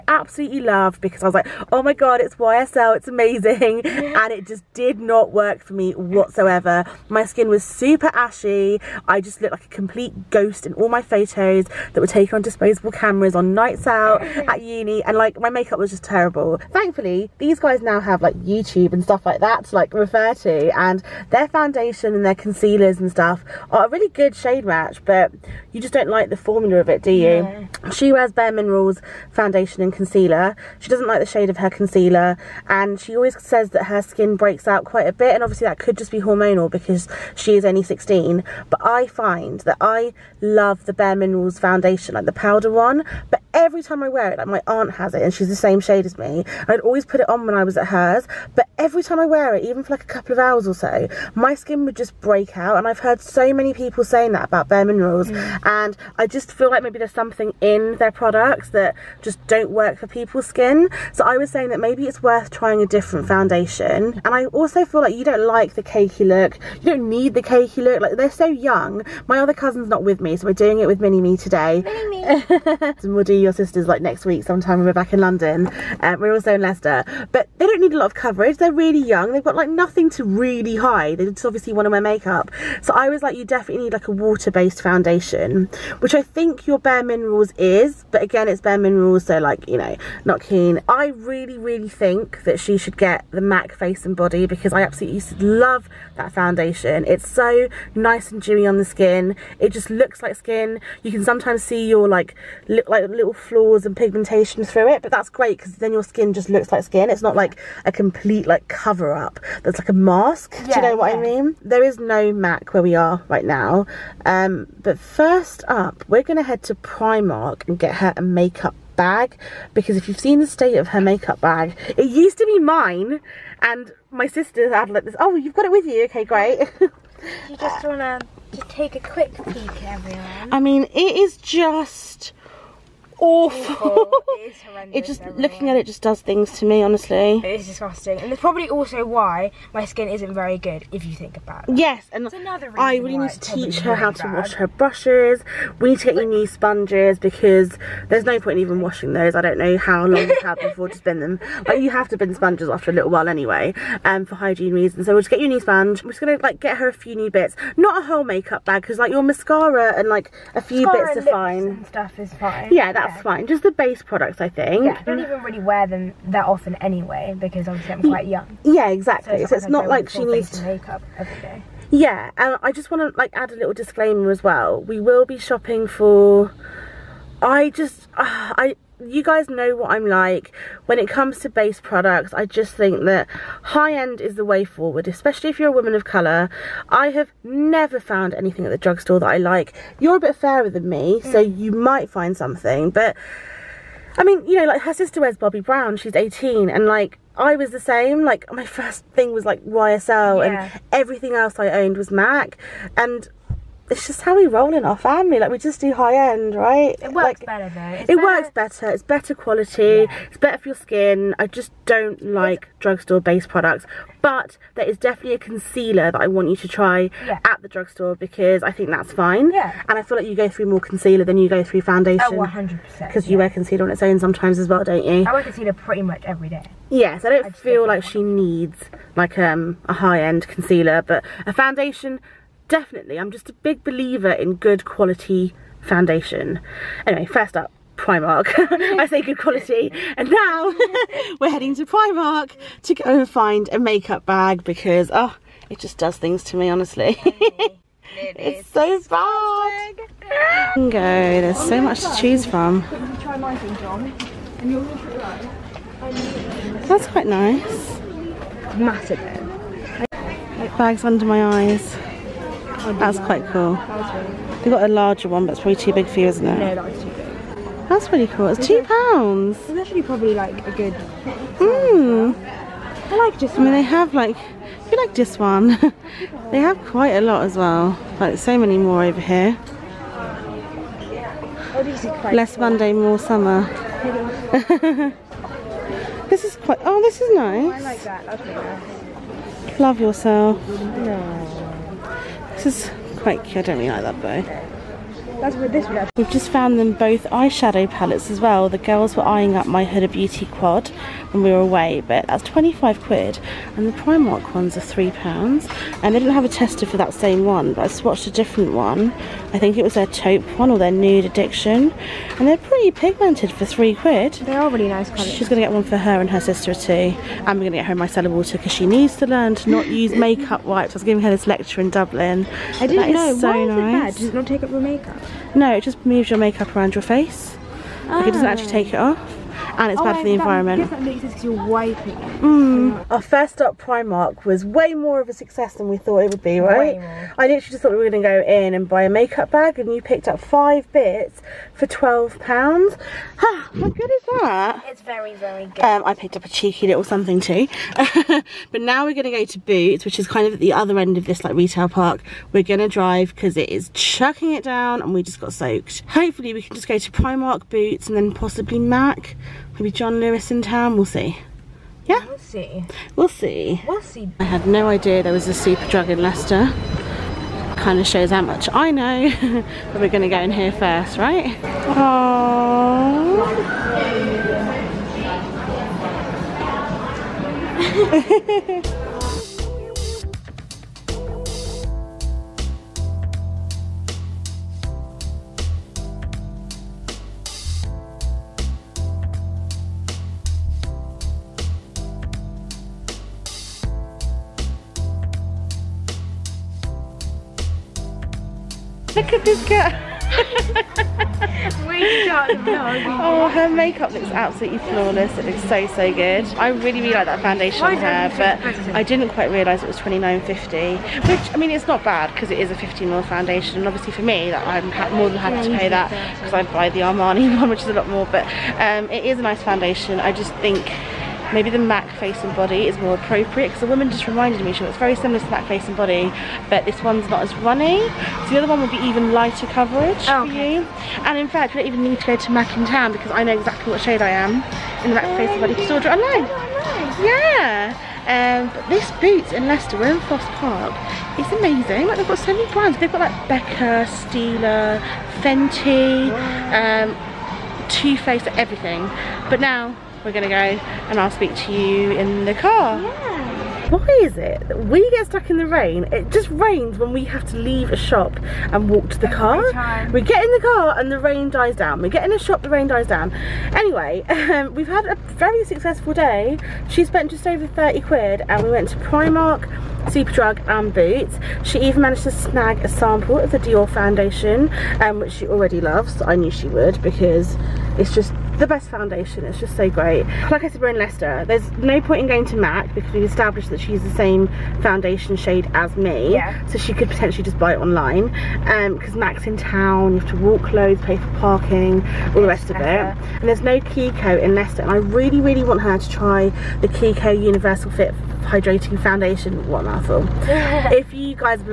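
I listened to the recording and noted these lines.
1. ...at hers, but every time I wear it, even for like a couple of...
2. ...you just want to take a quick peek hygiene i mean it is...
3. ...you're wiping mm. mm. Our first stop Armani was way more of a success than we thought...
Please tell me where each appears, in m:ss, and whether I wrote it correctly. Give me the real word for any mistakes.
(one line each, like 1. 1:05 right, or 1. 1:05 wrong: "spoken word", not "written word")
1. 0:47 right
2. 2:07 wrong: "everyone", not "hygiene"
3. 5:31 wrong: "Primark", not "Armani".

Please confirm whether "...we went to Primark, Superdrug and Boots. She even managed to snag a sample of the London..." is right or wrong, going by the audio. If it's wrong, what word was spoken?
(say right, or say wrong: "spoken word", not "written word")
wrong: "Dior", not "London".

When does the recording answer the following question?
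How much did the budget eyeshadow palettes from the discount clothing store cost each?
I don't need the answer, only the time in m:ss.
5:04.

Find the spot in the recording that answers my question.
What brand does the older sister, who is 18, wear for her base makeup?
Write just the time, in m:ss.
3:15.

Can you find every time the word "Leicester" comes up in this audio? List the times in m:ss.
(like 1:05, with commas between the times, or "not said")
1:16, 6:06, 7:19, 8:00, 8:14.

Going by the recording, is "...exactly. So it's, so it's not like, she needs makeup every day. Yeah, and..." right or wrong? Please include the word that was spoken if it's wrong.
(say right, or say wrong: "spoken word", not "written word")
right.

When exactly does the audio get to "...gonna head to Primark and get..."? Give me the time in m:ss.
1:56.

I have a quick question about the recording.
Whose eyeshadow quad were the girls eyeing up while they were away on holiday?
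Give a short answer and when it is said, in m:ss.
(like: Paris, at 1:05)
Huda Beauty, at 4:59.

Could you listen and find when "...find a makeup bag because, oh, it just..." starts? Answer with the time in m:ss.
4:03.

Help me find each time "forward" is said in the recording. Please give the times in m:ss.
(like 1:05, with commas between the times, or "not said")
3:04.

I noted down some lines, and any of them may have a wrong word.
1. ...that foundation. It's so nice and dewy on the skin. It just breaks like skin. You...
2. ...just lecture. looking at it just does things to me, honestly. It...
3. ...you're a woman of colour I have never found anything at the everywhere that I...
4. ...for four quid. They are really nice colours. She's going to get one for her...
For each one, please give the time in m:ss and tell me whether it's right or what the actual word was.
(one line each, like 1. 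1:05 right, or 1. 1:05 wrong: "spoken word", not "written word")
1. 1:36 wrong: "looks", not "breaks"
2. 2:15 wrong: "everywhere", not "lecture"
3. 3:05 wrong: "drugstore", not "everywhere"
4. 5:13 wrong: "three", not "four".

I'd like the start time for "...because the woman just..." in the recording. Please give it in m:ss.
7:03.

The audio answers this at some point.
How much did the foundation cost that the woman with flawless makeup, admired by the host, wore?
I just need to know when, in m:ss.
6:49.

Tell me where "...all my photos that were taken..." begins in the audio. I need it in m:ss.
0:10.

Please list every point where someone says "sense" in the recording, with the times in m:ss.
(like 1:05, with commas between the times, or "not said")
5:31.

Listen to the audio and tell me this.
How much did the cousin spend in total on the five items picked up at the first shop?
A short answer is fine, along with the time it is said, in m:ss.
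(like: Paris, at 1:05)
£12, at 5:41.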